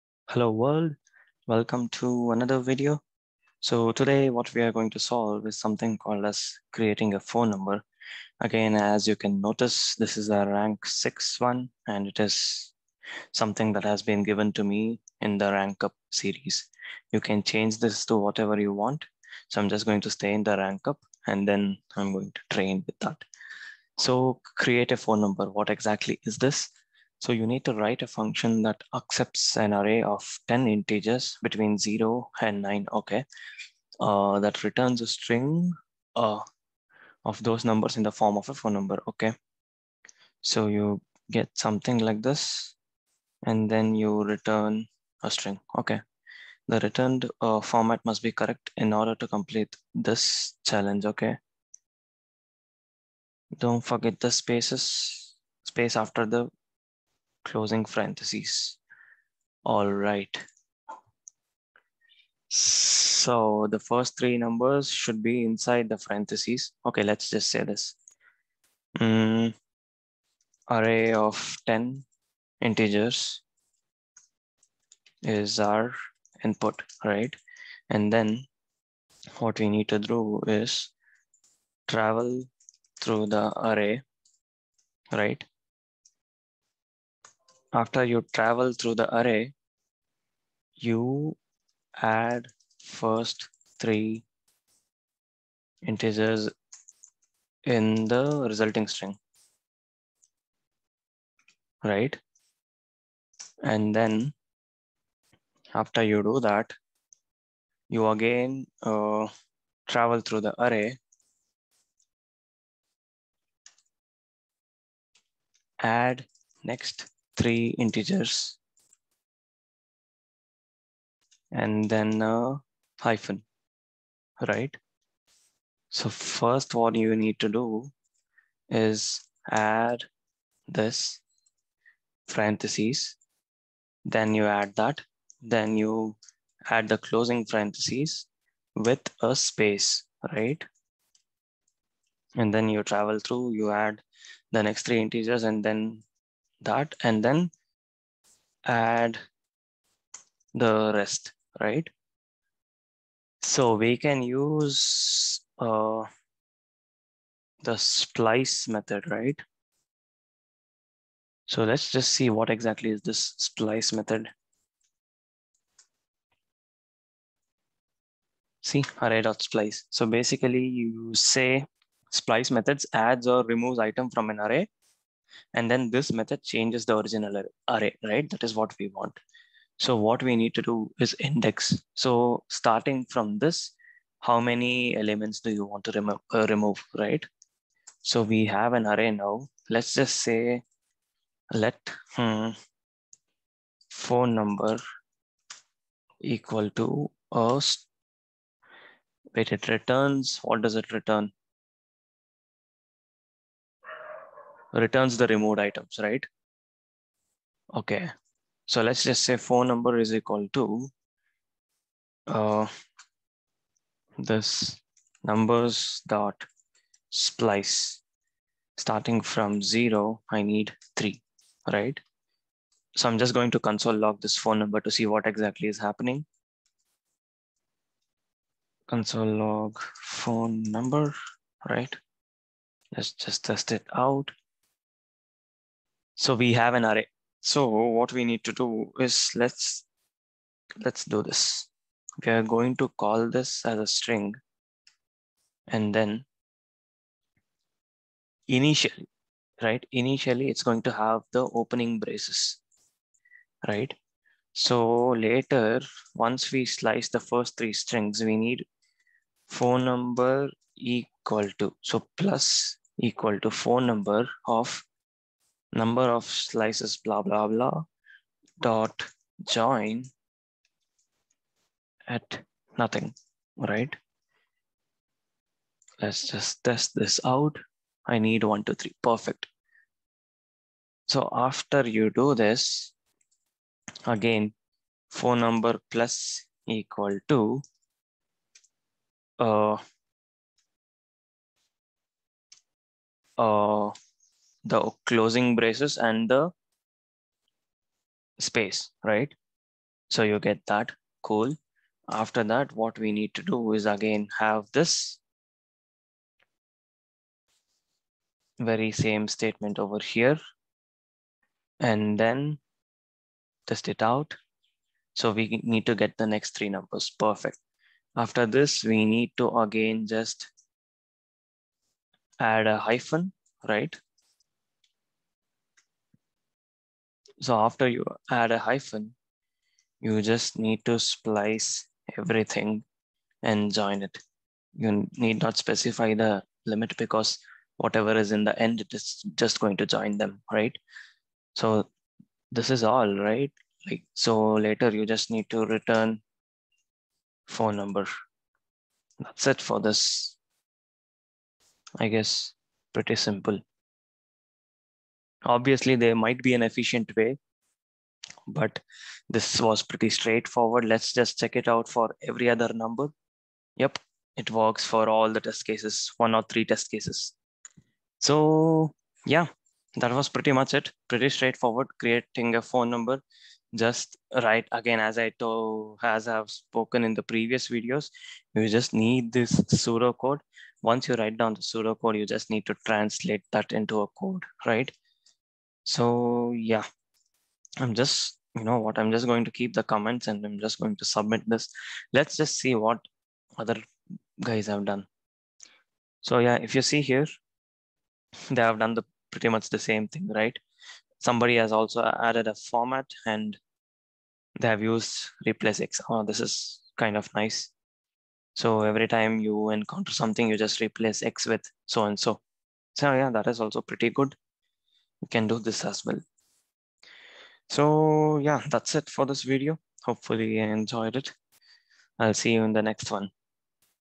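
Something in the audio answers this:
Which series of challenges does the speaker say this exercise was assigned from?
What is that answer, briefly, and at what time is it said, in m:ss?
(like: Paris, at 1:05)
rank up series, at 0:15.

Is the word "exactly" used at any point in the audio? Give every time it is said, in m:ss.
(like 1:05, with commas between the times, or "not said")
0:25, 2:42, 3:45.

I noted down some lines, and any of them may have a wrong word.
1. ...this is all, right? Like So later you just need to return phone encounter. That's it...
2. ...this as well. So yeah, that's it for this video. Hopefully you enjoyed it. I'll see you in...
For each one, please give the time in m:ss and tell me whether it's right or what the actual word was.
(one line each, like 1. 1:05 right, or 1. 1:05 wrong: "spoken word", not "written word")
1. 5:42 wrong: "number", not "encounter"
2. 6:55 right.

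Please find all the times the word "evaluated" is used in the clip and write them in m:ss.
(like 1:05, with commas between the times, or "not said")
not said.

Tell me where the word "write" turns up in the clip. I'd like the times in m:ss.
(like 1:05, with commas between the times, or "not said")
0:27, 6:14, 6:21.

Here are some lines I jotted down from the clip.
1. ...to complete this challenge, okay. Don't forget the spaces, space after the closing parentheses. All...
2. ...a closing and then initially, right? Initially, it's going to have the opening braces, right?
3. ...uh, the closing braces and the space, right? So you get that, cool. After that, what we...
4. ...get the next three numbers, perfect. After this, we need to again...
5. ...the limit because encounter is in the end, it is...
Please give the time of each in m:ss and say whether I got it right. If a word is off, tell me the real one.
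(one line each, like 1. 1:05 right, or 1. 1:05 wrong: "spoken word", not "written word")
1. 0:49 right
2. 4:03 wrong: "string", not "closing"
3. 4:53 right
4. 5:15 right
5. 5:36 wrong: "whatever", not "encounter".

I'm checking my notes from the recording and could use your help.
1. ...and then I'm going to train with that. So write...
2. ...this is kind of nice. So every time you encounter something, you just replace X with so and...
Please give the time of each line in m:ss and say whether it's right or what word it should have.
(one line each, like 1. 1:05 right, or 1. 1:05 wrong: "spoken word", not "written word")
1. 0:21 wrong: "create", not "write"
2. 6:46 right.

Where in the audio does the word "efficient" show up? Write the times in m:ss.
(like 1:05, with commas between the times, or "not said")
5:56.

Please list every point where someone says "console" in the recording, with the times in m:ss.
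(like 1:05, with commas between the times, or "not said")
3:43, 3:48.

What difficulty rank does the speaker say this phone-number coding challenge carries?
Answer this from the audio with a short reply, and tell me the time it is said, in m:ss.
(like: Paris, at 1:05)
rank 6, at 0:10.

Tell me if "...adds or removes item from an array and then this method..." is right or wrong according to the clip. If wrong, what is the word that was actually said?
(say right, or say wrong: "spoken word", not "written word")
right.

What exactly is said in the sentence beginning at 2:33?
So we can use uh, the splice method, right?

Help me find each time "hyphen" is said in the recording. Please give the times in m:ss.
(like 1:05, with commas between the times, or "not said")
2:02, 5:22, 5:28.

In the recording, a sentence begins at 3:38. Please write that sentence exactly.
Starting from zero, I need three, right?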